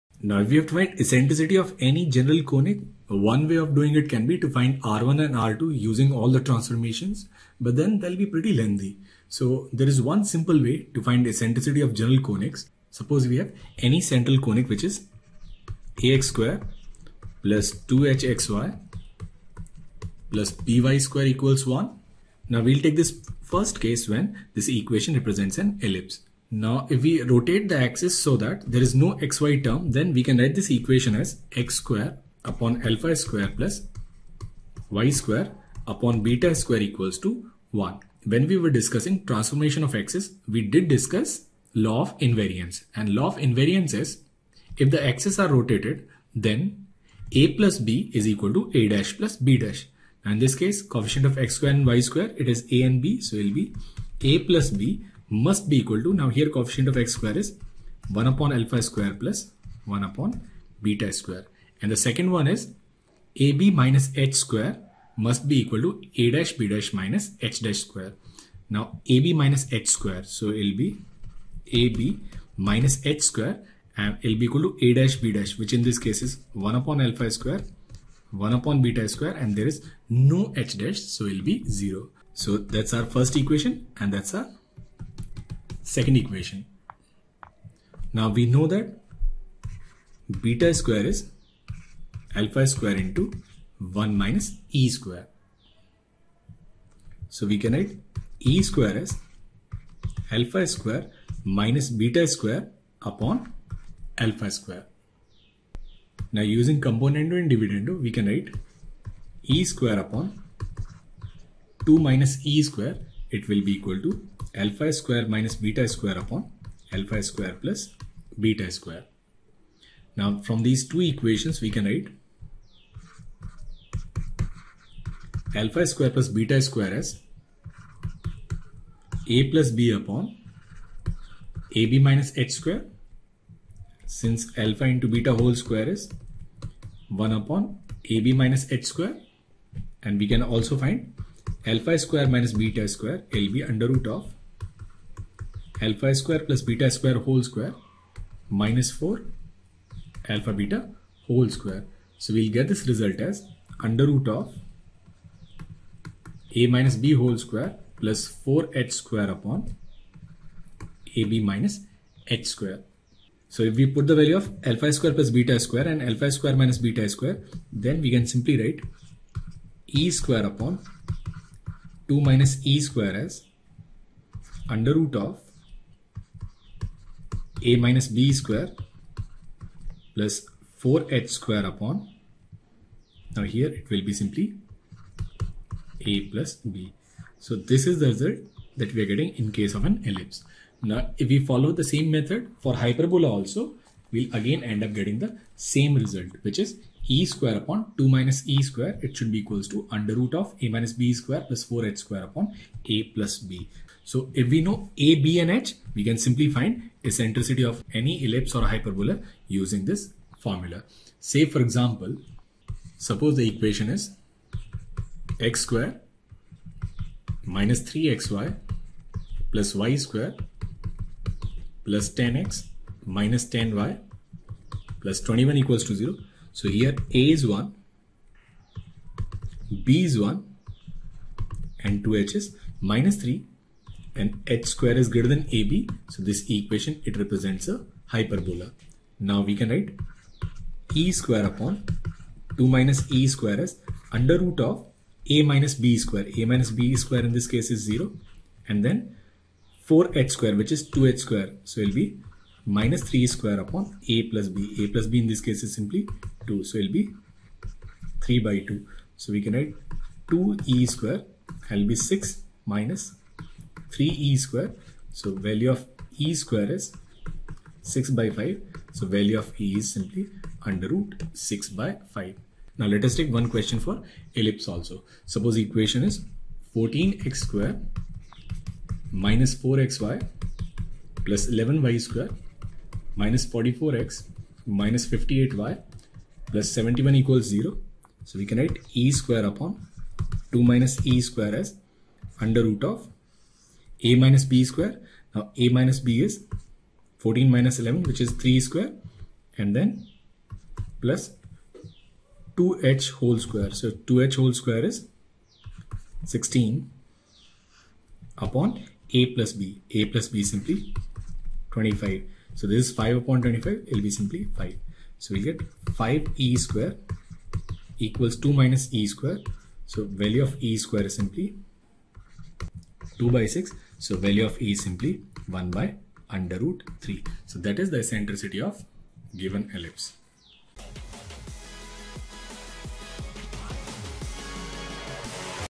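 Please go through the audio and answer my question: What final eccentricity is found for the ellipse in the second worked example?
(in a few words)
1/√3.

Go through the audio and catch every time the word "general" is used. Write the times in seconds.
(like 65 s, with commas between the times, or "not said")
2 s, 11 s.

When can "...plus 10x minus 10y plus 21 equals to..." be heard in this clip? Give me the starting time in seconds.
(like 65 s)
221 s.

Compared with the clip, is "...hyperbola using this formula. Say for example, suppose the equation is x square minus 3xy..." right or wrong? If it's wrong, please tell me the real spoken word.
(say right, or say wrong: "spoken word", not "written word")
right.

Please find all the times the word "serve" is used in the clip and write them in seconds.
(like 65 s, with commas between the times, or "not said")
not said.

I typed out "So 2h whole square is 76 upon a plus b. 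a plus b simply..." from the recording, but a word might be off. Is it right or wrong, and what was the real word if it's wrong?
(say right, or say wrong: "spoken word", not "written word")
wrong: "16", not "76".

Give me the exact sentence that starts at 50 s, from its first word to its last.
Now in this case, coefficient of x square and y square, it is a and b.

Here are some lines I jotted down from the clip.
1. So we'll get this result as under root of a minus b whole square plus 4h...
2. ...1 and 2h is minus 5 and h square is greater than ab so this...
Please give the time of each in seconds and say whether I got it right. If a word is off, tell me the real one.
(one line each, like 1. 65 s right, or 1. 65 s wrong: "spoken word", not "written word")
1. 152 s right
2. 230 s wrong: "3", not "5".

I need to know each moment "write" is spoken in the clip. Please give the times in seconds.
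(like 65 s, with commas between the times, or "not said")
30 s, 97 s, 108 s, 121 s, 168 s, 239 s, 259 s, 288 s.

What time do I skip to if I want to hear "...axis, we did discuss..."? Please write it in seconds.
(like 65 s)
39 s.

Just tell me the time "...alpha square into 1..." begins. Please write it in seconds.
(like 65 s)
92 s.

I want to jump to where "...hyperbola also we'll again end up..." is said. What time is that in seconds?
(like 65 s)
192 s.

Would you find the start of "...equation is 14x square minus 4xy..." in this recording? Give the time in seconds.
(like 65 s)
275 s.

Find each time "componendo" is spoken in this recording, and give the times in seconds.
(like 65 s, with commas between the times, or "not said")
106 s.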